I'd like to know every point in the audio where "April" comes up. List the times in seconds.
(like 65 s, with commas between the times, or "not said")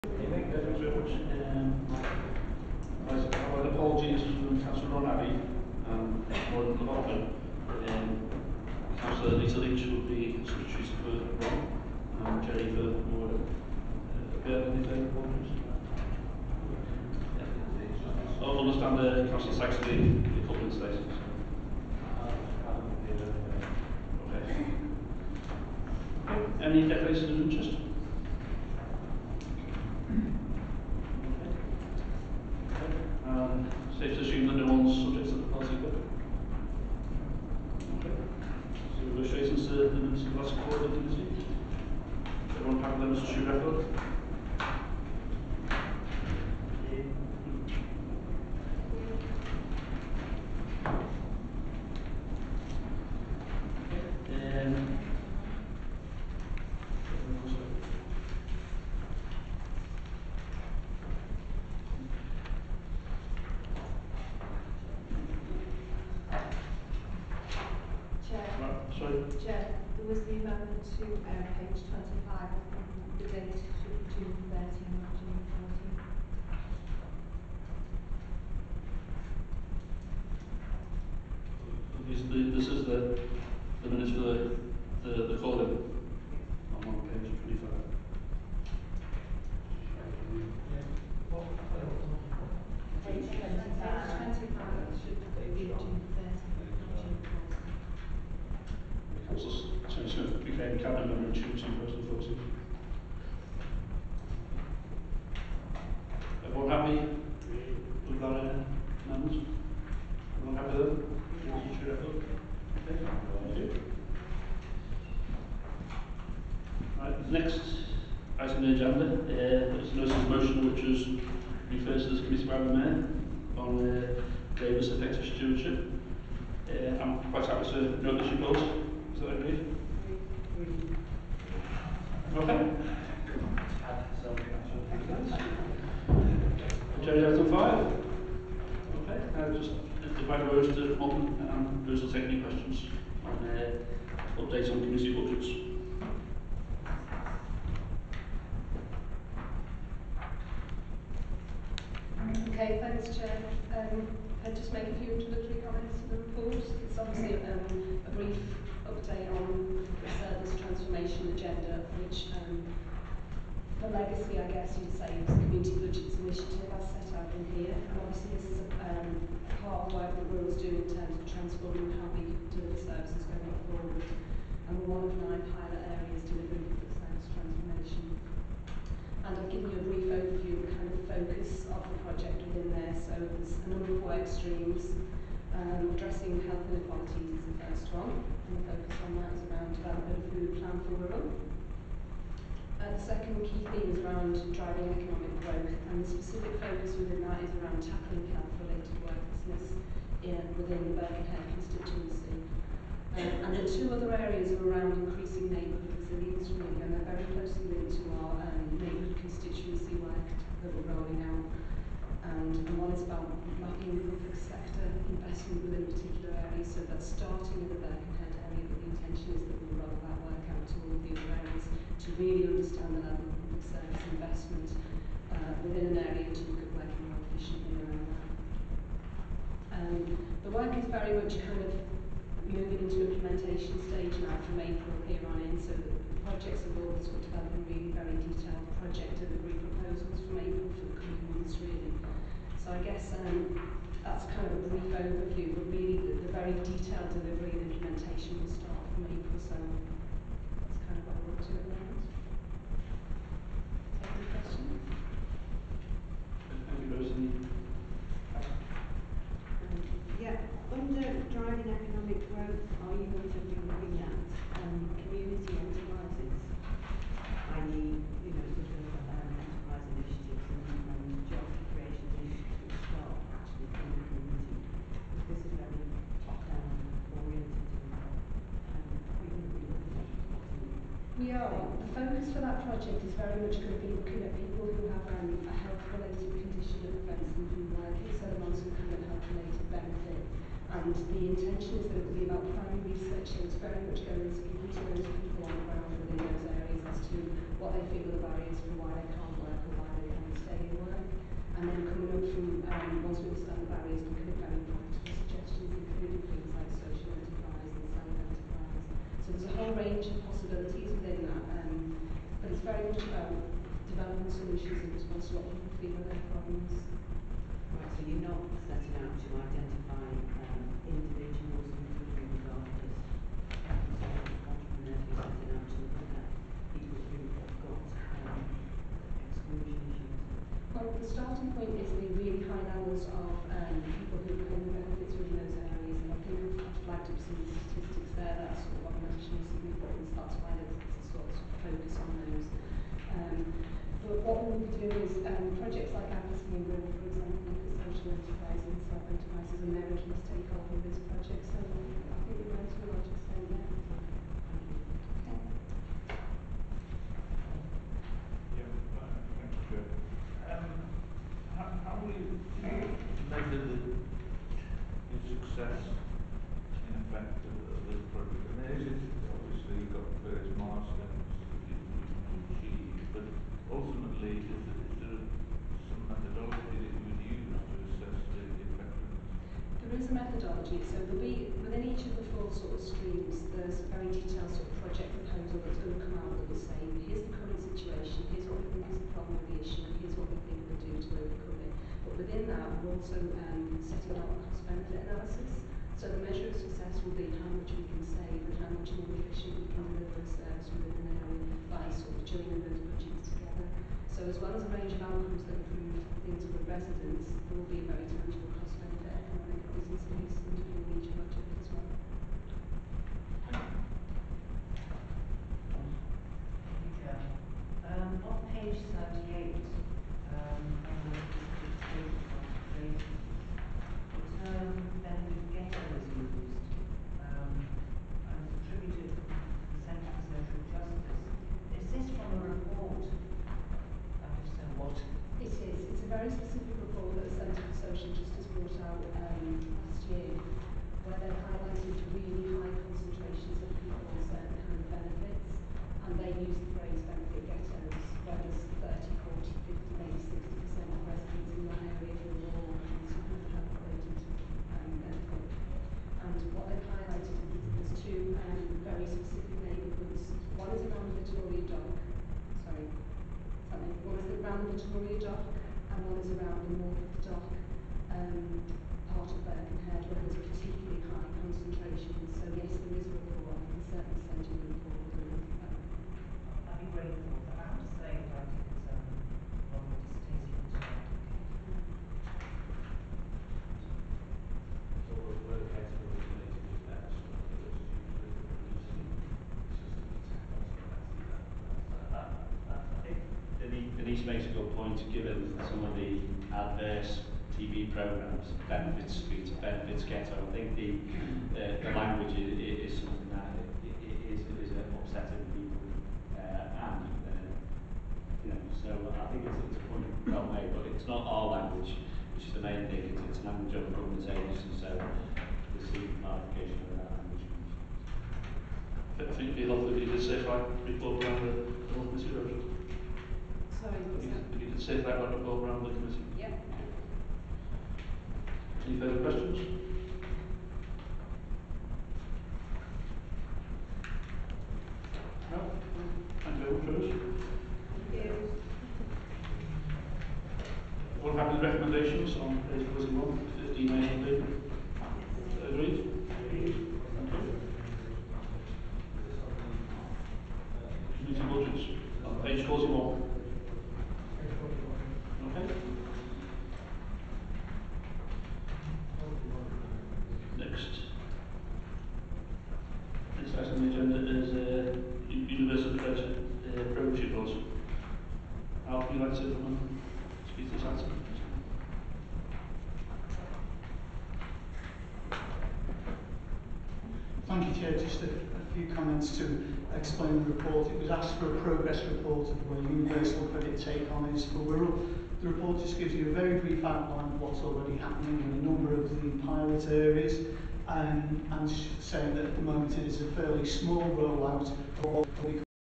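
234 s, 240 s, 249 s.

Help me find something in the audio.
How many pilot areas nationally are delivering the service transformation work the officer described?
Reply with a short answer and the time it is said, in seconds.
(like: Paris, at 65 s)
9, at 175 s.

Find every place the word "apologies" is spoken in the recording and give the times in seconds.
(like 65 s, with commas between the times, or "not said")
3 s, 15 s.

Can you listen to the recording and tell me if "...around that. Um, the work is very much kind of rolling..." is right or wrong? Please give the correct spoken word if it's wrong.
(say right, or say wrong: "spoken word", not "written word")
wrong: "moving", not "rolling".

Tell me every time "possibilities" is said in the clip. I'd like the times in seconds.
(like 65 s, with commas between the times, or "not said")
310 s.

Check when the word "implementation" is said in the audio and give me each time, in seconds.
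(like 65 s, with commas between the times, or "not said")
233 s, 247 s, 513 s.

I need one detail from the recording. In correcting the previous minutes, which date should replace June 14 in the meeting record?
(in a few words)
June 13.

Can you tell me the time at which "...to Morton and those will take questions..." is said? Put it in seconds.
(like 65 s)
140 s.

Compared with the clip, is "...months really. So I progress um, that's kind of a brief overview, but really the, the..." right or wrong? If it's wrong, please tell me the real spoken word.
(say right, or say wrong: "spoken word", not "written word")
wrong: "guess", not "progress".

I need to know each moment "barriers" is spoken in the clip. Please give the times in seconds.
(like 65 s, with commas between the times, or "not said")
298 s, 303 s.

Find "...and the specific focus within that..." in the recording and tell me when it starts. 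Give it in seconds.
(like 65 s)
195 s.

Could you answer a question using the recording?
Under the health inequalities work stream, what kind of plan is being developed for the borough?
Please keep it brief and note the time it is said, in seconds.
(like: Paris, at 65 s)
Food plan, at 190 s.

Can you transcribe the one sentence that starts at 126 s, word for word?
Uh, I'm quite happy to note this report.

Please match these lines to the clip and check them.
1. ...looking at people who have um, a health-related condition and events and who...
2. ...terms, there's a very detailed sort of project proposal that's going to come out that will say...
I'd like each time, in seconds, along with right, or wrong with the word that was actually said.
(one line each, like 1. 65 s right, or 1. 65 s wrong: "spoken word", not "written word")
1. 283 s right
2. 382 s wrong: "streams", not "terms".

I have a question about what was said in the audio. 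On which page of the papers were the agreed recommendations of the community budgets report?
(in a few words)
41.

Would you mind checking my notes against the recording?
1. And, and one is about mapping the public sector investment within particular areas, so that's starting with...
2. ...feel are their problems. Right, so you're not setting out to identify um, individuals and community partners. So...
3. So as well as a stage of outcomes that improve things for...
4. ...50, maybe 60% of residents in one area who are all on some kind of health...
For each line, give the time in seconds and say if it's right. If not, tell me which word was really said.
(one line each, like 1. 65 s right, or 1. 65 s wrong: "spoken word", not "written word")
1. 212 s right
2. 315 s right
3. 404 s wrong: "range", not "stage"
4. 449 s right.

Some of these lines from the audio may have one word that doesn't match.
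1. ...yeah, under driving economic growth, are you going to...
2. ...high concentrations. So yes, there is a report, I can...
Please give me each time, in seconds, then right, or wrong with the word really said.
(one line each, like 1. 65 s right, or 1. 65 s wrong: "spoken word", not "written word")
1. 260 s right
2. 471 s right.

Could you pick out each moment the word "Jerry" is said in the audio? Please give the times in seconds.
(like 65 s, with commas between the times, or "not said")
12 s, 137 s.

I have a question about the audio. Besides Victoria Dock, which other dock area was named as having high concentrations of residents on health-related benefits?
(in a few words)
Morpeth Dock.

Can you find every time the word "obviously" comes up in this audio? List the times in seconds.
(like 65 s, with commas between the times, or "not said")
156 s, 167 s.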